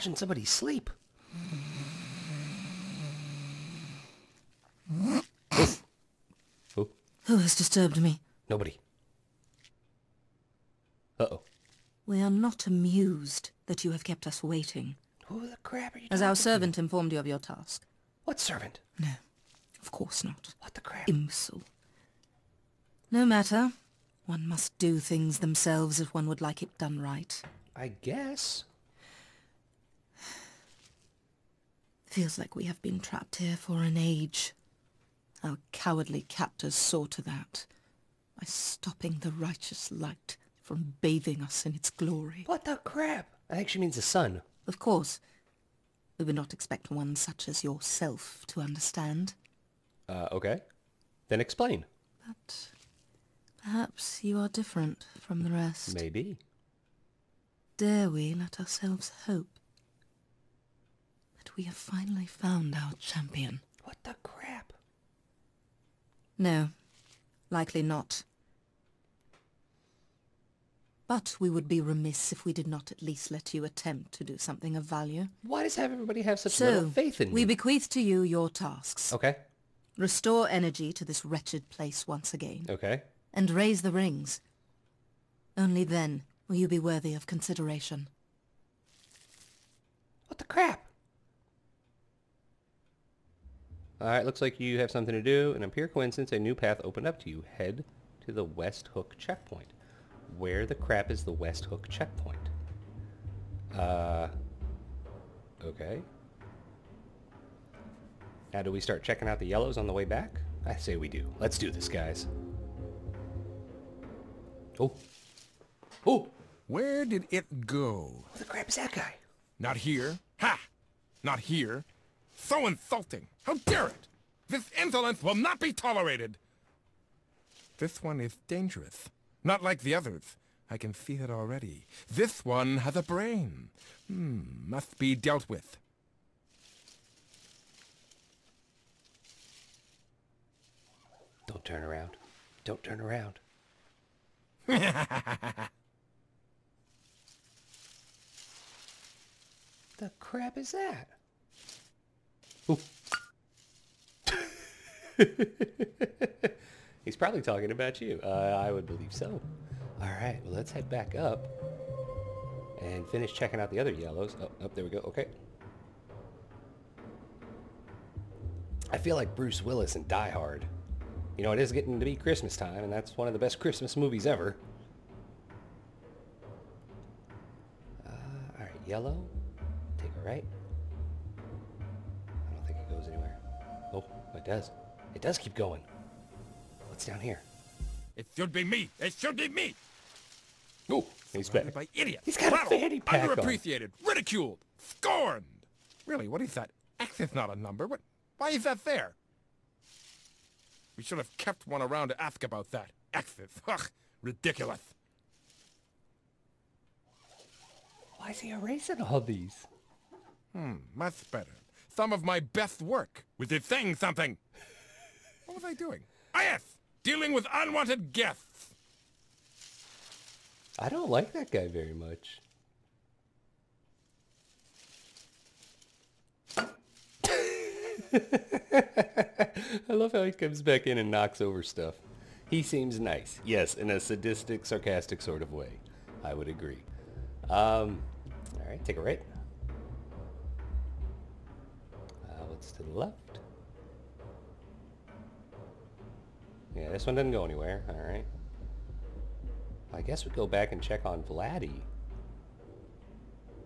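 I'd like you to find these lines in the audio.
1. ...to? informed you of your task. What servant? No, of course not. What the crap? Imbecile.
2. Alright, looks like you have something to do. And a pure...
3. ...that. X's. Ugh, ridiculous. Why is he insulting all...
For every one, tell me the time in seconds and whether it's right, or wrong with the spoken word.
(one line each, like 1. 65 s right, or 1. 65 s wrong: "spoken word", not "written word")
1. 16 s right
2. 93 s right
3. 202 s wrong: "erasing", not "insulting".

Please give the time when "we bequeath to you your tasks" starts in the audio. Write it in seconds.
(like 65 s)
77 s.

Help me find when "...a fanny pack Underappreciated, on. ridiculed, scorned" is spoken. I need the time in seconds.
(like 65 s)
192 s.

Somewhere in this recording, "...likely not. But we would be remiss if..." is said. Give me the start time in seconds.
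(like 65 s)
67 s.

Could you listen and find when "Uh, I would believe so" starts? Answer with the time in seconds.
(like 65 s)
158 s.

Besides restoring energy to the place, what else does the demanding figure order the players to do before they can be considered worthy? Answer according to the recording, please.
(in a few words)
Raise the rings.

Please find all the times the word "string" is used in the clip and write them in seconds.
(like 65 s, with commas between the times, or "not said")
not said.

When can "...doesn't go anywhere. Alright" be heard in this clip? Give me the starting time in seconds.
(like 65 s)
247 s.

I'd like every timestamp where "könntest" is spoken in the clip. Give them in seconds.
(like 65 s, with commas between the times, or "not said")
not said.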